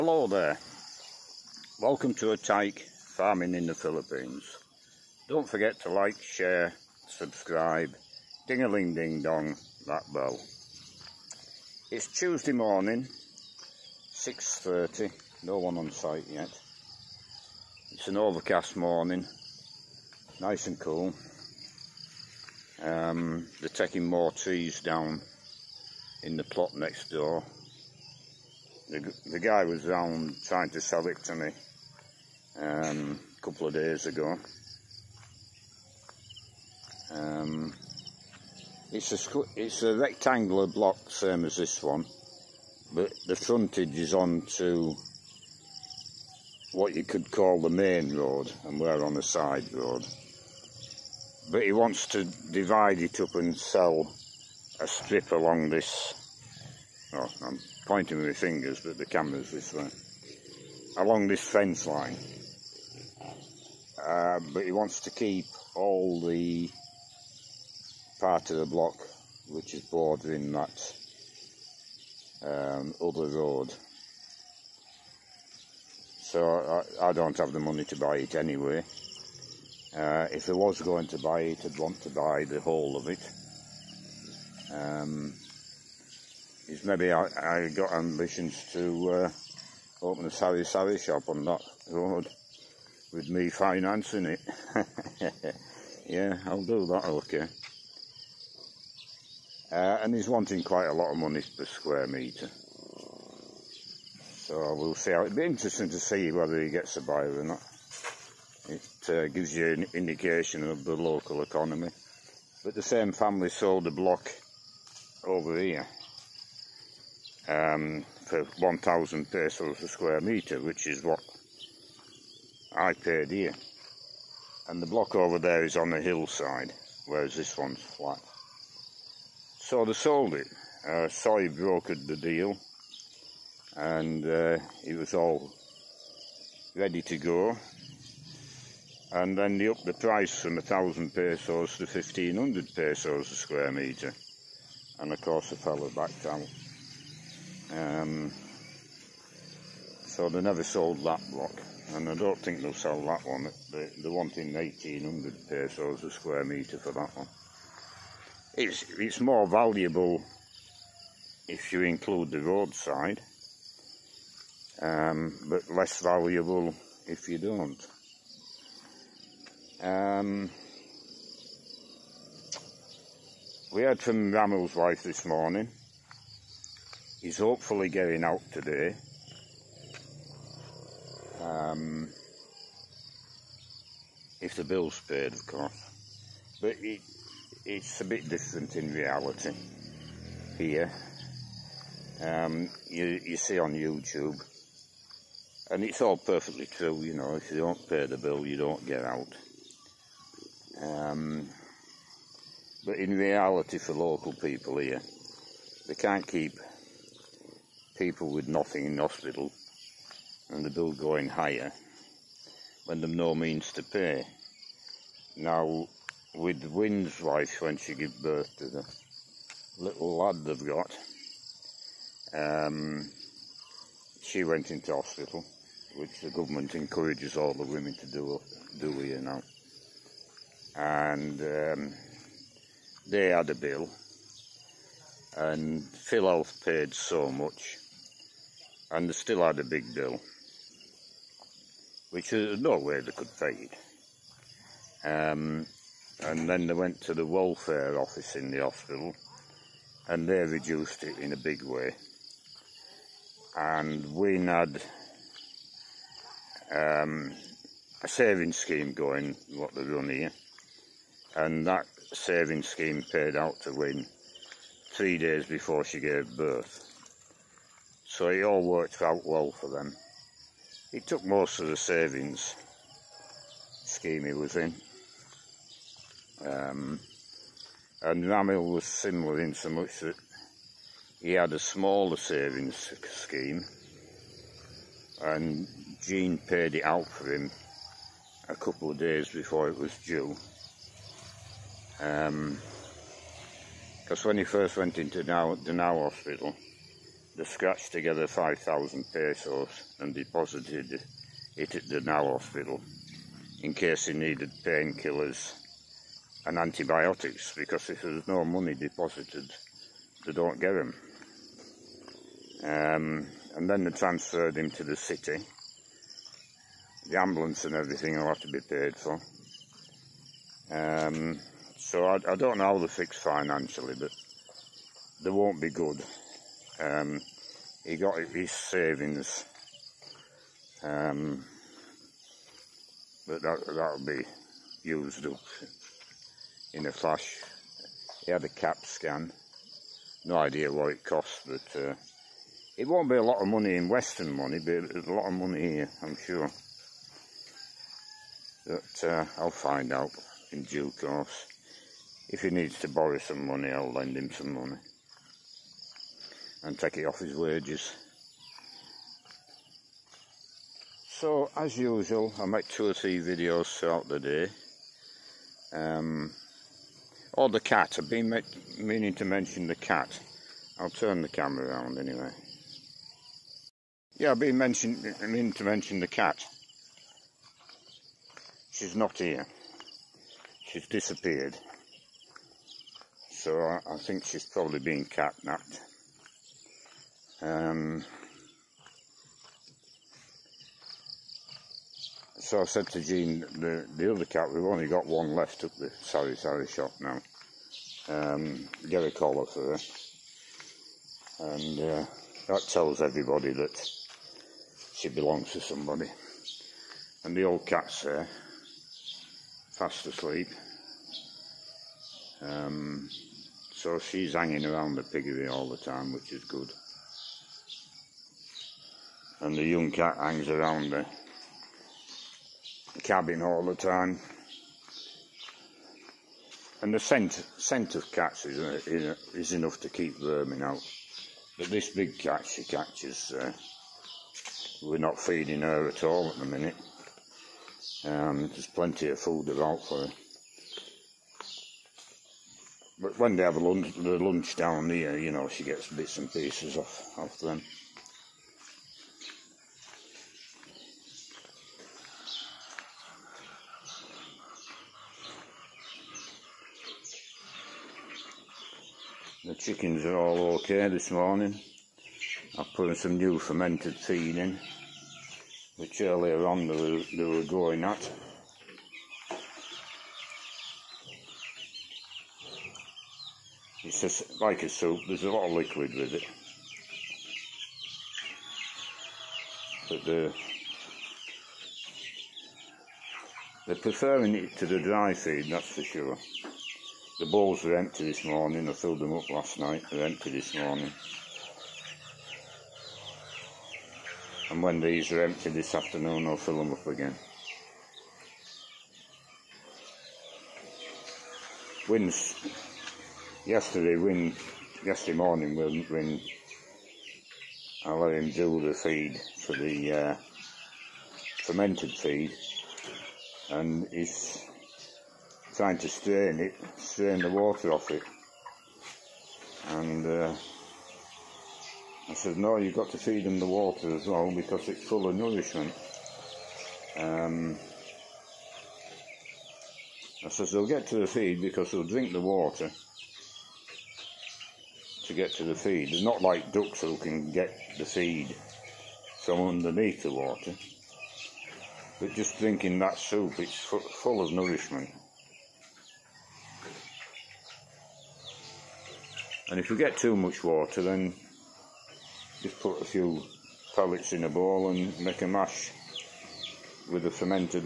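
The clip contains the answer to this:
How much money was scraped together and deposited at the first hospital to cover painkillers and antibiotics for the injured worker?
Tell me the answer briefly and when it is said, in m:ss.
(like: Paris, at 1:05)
5,000 pesos, at 4:58.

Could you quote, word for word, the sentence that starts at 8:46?
Um, I says, they'll get to the feed because they'll drink the water to get to the feed.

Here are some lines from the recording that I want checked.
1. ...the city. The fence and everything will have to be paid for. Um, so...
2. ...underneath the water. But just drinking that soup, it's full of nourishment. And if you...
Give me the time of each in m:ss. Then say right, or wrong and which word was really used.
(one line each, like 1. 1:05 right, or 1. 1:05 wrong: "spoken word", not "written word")
1. 5:14 wrong: "ambulance", not "fence"
2. 8:59 right.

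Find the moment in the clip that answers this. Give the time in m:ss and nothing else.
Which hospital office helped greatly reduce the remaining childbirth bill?
4:07.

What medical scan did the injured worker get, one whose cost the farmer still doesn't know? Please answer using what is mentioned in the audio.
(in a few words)
CAT scan.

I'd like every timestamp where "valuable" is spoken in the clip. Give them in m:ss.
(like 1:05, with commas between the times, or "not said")
2:39, 2:46.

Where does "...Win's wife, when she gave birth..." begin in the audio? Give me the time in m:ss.
3:36.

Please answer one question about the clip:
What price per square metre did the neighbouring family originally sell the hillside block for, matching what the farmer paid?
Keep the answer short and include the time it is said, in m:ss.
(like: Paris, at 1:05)
1,000 pesos, at 1:58.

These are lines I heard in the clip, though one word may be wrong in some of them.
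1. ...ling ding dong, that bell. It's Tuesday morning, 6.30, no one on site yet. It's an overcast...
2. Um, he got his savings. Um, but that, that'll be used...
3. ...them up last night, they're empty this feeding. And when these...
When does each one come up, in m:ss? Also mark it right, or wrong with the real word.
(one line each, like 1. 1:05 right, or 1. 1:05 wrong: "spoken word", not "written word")
1. 0:08 right
2. 5:26 right
3. 8:08 wrong: "morning", not "feeding".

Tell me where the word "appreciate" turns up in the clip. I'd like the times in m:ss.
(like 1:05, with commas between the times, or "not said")
not said.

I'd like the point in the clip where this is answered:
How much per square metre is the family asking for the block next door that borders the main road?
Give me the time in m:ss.
2:34.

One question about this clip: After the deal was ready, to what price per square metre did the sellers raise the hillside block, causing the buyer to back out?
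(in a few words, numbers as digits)
1,500 pesos.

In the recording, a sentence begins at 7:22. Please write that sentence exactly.
But when they have lunch, the lunch down here, you know, she gets bits and pieces off, off them.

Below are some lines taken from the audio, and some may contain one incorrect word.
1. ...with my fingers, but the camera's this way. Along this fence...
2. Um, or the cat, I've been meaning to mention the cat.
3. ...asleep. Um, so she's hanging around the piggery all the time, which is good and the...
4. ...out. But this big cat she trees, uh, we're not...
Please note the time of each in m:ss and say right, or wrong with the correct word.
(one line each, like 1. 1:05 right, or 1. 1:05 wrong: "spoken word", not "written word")
1. 0:58 right
2. 6:05 right
3. 6:50 right
4. 7:10 wrong: "catches", not "trees".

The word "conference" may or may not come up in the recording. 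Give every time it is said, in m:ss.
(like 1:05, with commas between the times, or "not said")
not said.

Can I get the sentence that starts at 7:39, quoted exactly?
chickens are all okay this morning.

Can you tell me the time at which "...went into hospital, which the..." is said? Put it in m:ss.
3:44.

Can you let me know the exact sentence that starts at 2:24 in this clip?
And of course the fellow backed out.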